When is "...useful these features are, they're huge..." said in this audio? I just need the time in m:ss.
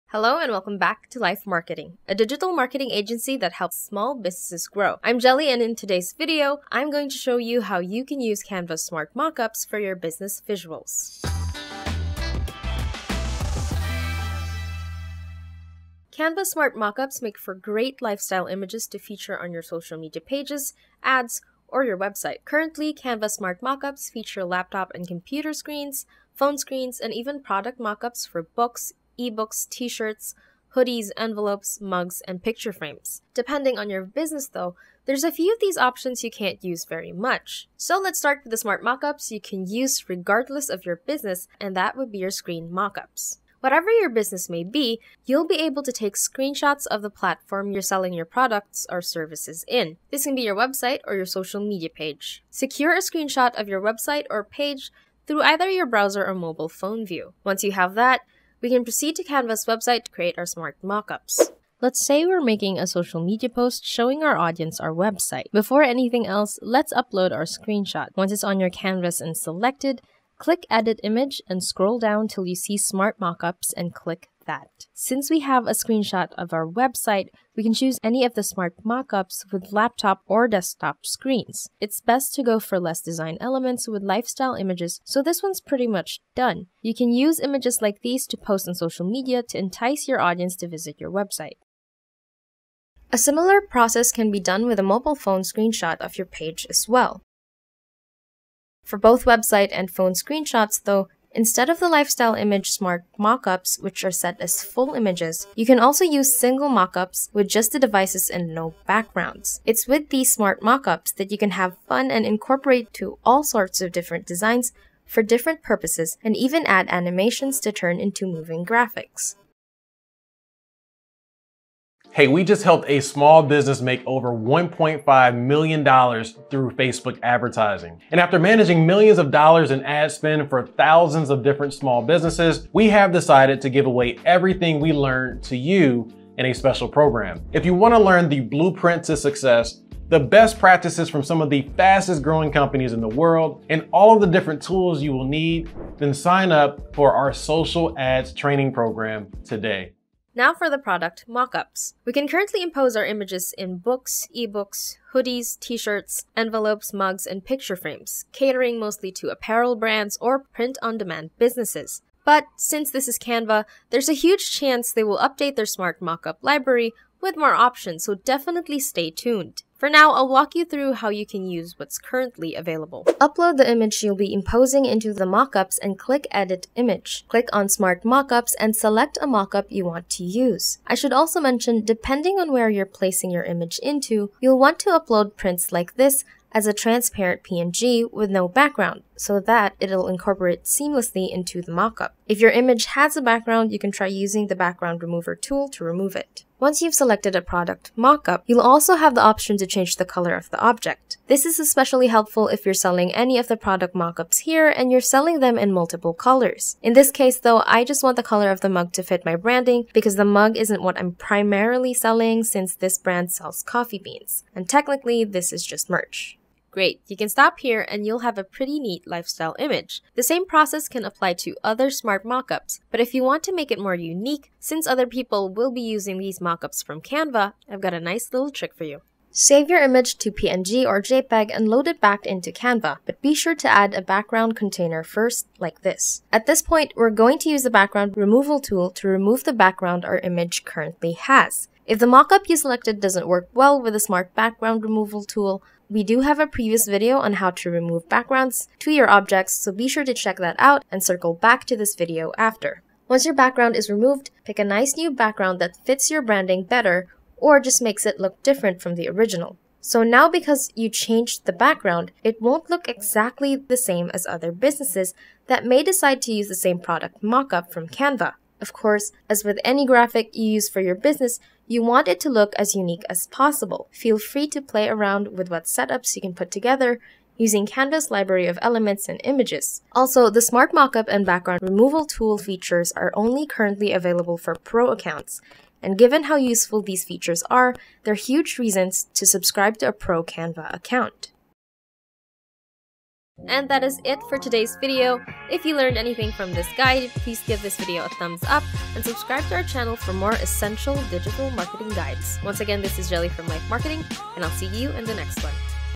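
4:46.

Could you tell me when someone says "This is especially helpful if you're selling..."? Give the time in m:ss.
3:21.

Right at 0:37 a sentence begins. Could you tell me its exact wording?
So let's start with the smart mockups you can use regardless of your business, and that would be your screen mockups.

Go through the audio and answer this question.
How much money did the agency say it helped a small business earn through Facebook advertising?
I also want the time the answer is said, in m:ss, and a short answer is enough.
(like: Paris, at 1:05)
$1.5 million, at 2:04.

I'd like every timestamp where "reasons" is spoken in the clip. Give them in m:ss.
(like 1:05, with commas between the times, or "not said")
4:48.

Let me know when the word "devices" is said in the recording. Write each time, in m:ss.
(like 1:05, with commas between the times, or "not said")
1:47.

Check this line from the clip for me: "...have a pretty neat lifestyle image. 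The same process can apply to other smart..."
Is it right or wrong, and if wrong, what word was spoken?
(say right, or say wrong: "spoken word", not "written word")
right.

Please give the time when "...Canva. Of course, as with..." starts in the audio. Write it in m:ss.
4:27.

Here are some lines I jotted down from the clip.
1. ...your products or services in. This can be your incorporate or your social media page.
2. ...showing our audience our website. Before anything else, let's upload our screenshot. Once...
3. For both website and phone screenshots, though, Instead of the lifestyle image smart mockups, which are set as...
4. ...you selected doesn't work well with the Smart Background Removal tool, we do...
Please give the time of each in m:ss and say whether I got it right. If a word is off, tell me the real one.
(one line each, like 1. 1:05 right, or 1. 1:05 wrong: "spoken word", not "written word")
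1. 0:48 wrong: "website", not "incorporate"
2. 1:03 right
3. 1:38 right
4. 4:02 right.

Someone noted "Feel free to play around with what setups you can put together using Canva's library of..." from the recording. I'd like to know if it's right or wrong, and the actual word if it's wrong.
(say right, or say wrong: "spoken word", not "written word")
right.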